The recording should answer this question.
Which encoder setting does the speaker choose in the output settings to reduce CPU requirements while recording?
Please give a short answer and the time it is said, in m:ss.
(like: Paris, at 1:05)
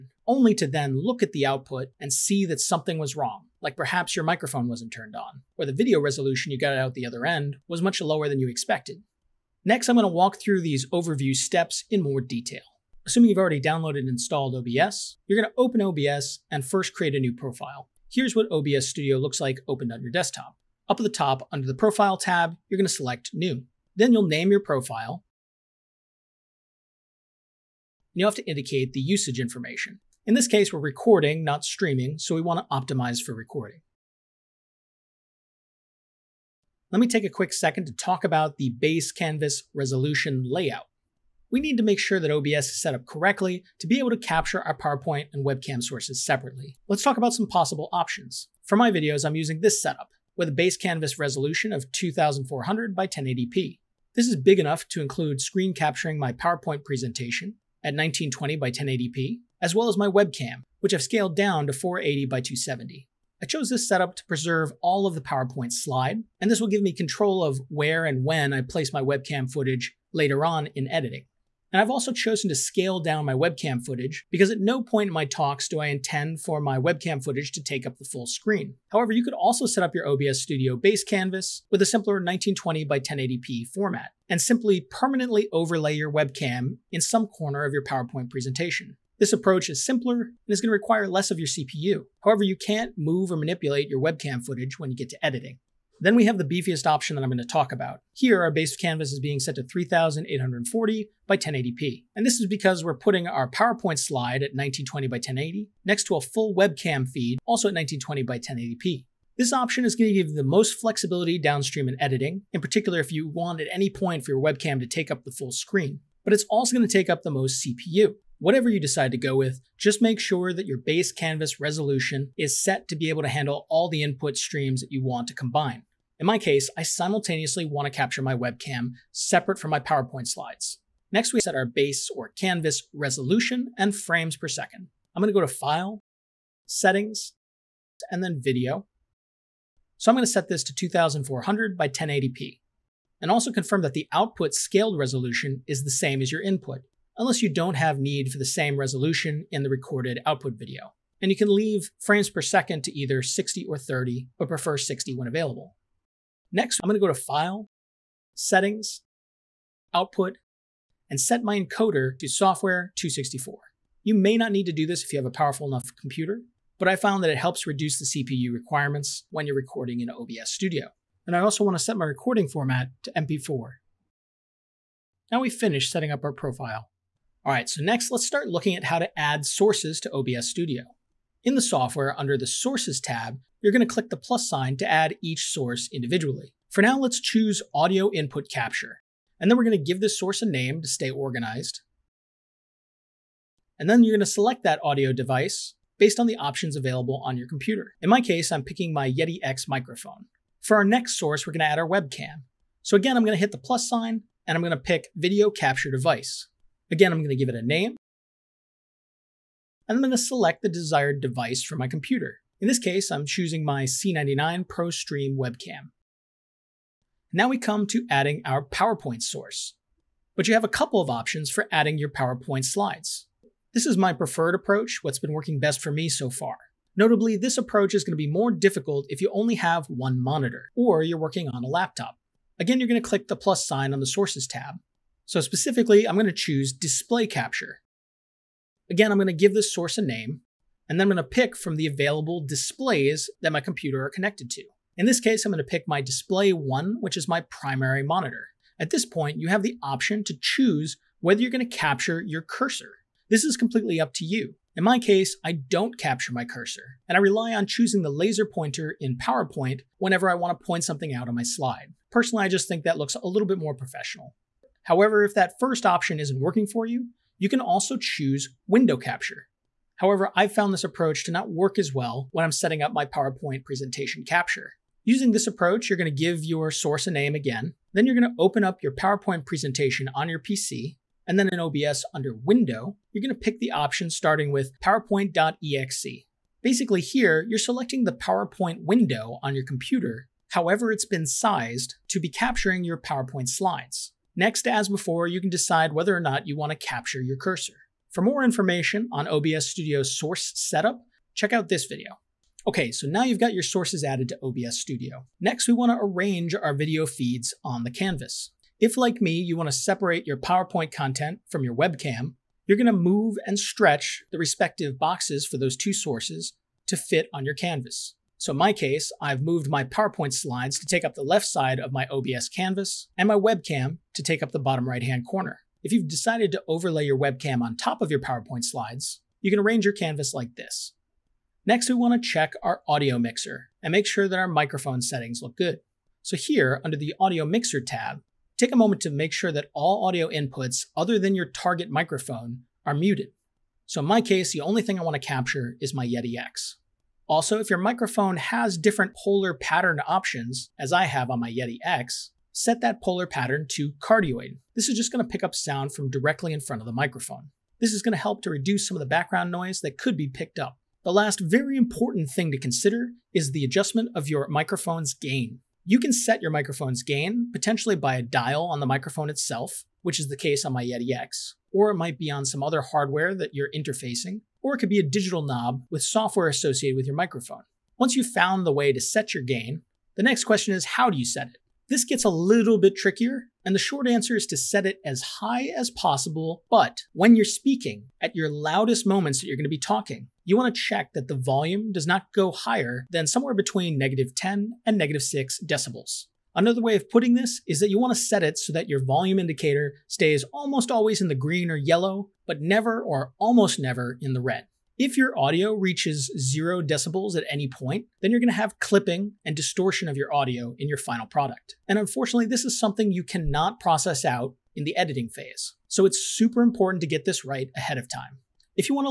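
Software 264, at 2:42.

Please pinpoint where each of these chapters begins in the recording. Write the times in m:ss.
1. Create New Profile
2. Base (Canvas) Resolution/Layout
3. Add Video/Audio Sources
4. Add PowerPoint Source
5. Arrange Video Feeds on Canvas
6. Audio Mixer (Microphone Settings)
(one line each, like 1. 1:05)
1. 0:12
2. 0:36
3. 2:56
4. 3:36
5. 5:02
6. 5:46.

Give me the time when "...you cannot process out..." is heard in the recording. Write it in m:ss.
6:53.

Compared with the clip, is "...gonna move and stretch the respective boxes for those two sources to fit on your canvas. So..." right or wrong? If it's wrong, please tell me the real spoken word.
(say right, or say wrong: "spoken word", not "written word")
right.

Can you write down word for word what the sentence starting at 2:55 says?
Now we've finished setting up our profile.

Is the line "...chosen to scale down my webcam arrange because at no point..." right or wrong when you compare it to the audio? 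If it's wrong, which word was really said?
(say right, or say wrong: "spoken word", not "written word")
wrong: "footage", not "arrange".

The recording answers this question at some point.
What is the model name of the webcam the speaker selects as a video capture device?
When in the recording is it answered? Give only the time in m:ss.
3:33.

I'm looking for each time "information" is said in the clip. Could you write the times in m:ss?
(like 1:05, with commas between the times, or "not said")
0:29, 4:58.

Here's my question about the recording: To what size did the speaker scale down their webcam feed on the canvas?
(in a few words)
480 by 270.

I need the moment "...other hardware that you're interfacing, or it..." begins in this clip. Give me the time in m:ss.
6:12.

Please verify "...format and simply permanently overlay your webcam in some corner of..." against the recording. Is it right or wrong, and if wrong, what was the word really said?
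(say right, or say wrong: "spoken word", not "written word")
right.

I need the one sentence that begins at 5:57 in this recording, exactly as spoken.
This is going to help to reduce some of the background noise that could be picked up.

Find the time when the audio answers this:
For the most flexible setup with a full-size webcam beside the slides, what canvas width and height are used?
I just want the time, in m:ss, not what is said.
1:39.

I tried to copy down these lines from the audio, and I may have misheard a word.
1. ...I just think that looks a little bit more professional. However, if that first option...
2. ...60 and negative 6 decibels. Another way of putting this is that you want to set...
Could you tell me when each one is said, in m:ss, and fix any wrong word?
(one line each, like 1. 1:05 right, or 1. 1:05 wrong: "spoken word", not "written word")
1. 4:22 right
2. 6:34 wrong: "10", not "60".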